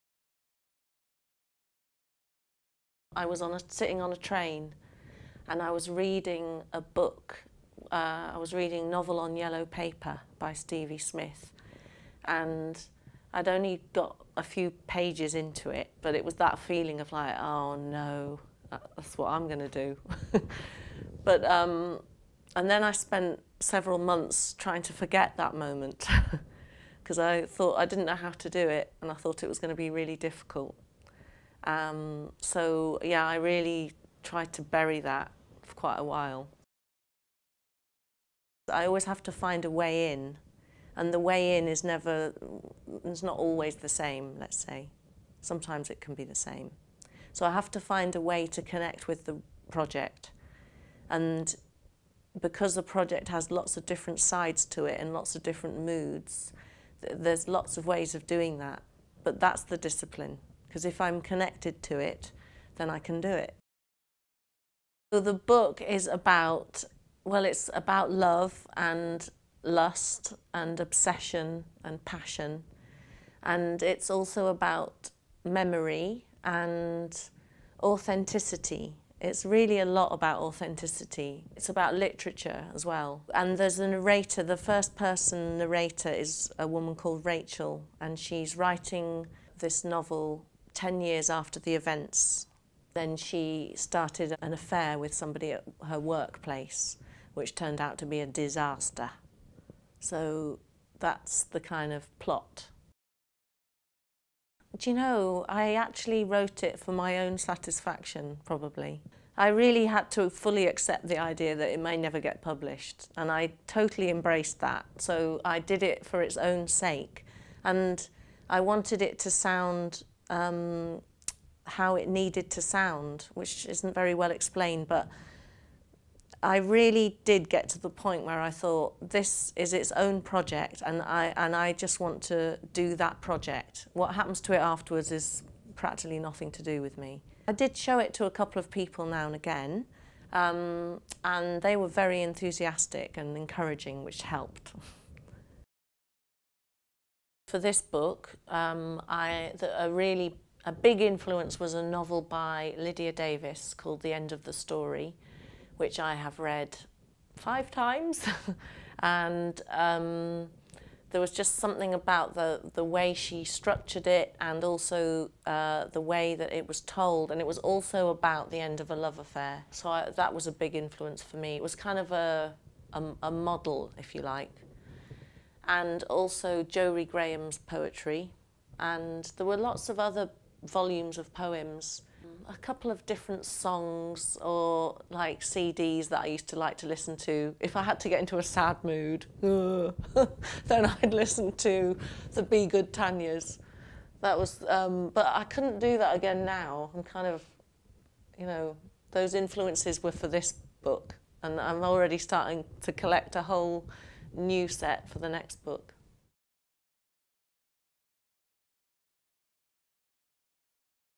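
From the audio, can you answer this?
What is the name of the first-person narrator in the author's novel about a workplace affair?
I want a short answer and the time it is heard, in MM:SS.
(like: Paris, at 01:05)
Rachel, at 01:27.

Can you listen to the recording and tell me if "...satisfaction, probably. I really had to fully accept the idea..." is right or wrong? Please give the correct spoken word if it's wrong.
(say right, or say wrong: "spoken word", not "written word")
right.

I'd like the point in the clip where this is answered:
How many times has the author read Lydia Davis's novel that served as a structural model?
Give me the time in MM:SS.
02:37.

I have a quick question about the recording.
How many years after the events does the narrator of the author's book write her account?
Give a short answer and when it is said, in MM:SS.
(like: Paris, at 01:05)
10, at 01:30.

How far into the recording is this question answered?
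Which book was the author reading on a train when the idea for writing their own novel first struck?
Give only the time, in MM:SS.
00:08.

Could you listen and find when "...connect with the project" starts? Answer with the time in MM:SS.
00:48.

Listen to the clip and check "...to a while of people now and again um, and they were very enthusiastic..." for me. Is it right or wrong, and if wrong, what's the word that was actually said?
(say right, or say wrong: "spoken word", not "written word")
wrong: "couple", not "while".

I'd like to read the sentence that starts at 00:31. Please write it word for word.
Um, so yeah, I really tried to bury that for quite a while.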